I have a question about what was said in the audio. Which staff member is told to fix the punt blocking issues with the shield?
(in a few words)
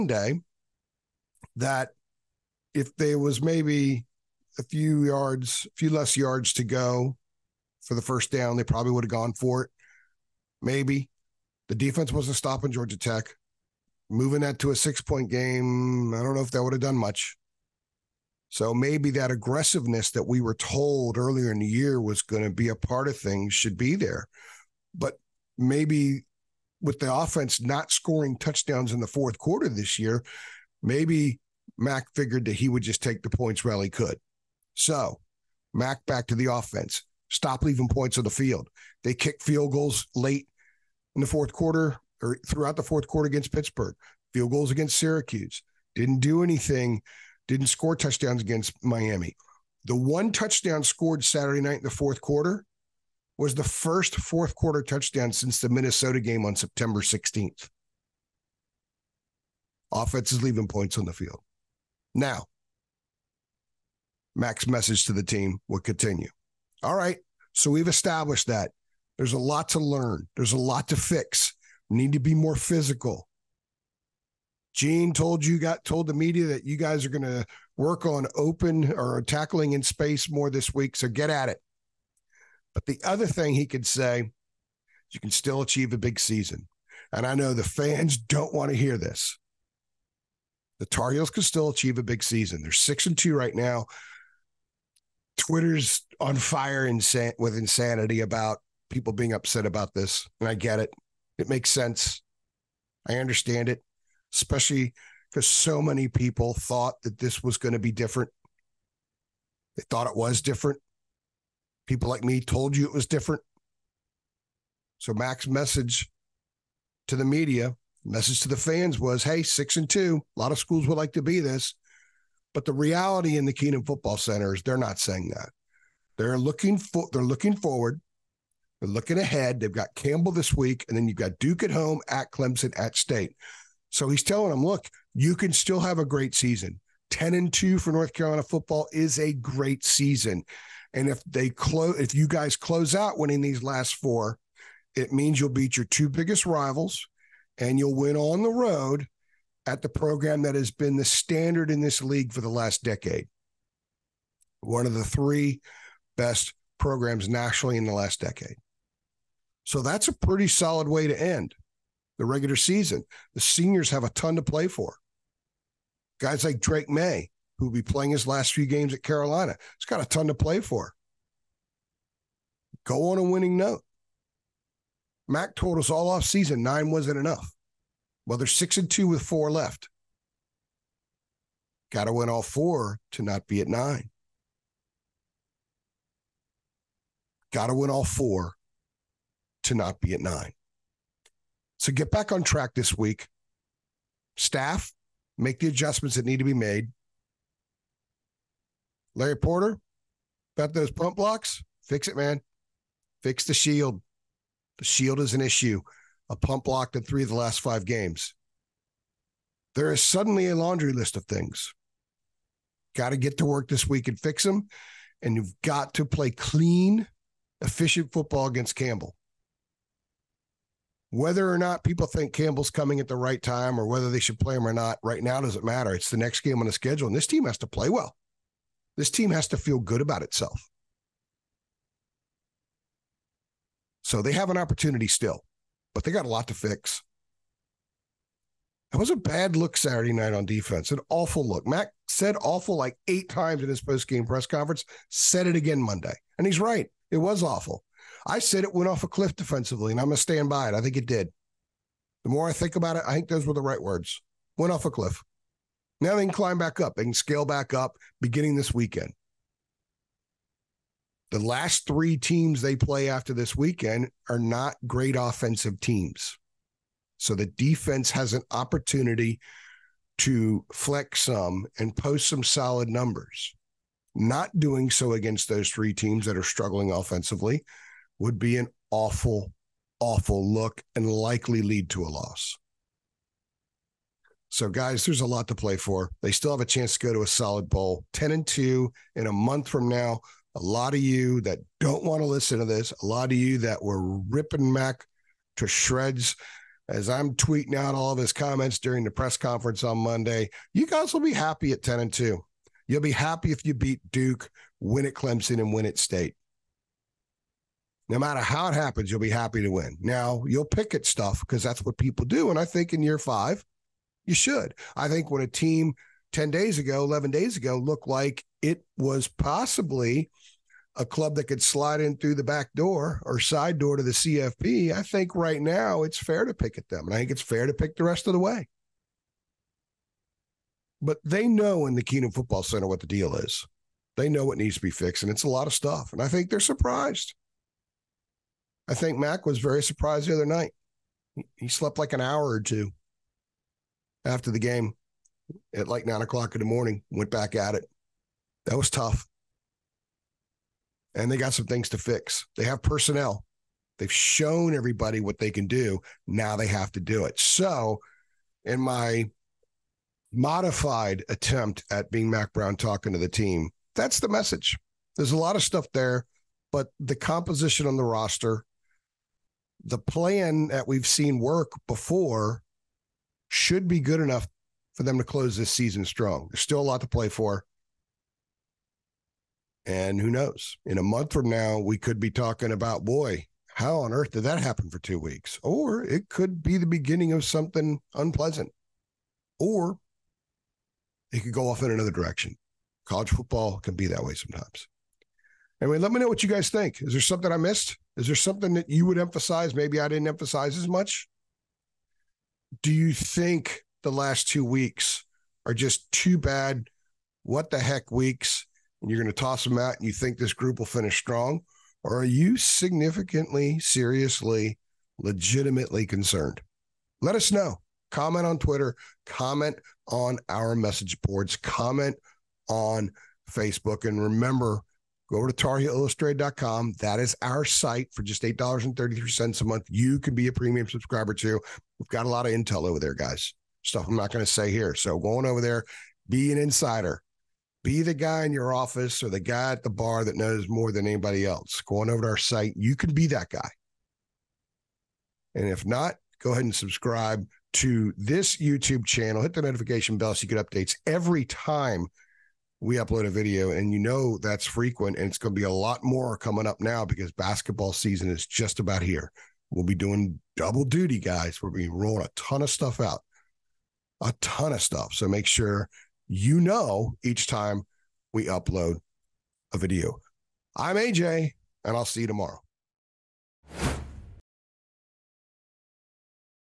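Larry Porter.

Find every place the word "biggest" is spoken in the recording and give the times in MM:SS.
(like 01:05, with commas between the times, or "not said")
02:26.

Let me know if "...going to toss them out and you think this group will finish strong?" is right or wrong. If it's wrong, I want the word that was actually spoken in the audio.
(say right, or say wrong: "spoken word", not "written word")
right.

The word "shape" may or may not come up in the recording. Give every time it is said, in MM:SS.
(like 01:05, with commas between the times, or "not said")
not said.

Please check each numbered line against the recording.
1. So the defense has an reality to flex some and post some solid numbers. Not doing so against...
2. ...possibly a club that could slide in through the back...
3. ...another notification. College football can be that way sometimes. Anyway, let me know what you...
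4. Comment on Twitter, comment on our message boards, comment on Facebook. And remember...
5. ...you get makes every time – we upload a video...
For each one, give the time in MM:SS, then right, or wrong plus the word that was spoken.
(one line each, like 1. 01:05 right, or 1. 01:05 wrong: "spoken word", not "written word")
1. 04:27 wrong: "opportunity", not "reality"
2. 05:19 right
3. 06:31 wrong: "direction", not "notification"
4. 06:58 right
5. 07:30 wrong: "updates", not "makes".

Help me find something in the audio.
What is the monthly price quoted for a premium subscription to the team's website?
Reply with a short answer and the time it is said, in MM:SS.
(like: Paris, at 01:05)
$8.33, at 07:08.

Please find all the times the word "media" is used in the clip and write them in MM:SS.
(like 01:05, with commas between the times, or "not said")
01:16, 01:57.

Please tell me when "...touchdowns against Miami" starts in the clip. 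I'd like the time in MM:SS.
00:47.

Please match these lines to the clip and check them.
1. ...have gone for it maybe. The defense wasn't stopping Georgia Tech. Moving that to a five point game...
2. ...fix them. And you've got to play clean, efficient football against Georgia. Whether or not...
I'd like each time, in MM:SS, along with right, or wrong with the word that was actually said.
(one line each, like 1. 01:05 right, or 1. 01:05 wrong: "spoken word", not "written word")
1. 00:09 wrong: "six", not "five"
2. 03:34 wrong: "Campbell", not "Georgia".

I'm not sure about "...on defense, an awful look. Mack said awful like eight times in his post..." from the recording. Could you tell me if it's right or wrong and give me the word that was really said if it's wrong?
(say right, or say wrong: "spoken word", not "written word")
right.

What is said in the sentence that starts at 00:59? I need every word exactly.
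Offense is leaving points on the field.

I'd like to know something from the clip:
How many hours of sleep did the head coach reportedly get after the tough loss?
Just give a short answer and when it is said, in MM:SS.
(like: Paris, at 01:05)
1 or 2, at 05:42.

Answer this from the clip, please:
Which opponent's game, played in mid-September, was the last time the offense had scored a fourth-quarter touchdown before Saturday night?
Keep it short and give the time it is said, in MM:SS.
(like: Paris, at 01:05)
Minnesota, at 00:55.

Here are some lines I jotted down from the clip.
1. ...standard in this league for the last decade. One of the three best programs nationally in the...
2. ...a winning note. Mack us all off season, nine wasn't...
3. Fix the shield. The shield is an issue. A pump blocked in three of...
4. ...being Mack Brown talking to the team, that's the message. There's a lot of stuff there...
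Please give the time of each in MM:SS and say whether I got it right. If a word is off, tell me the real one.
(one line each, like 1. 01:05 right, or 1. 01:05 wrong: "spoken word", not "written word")
1. 02:31 right
2. 02:53 right
3. 03:23 right
4. 06:02 right.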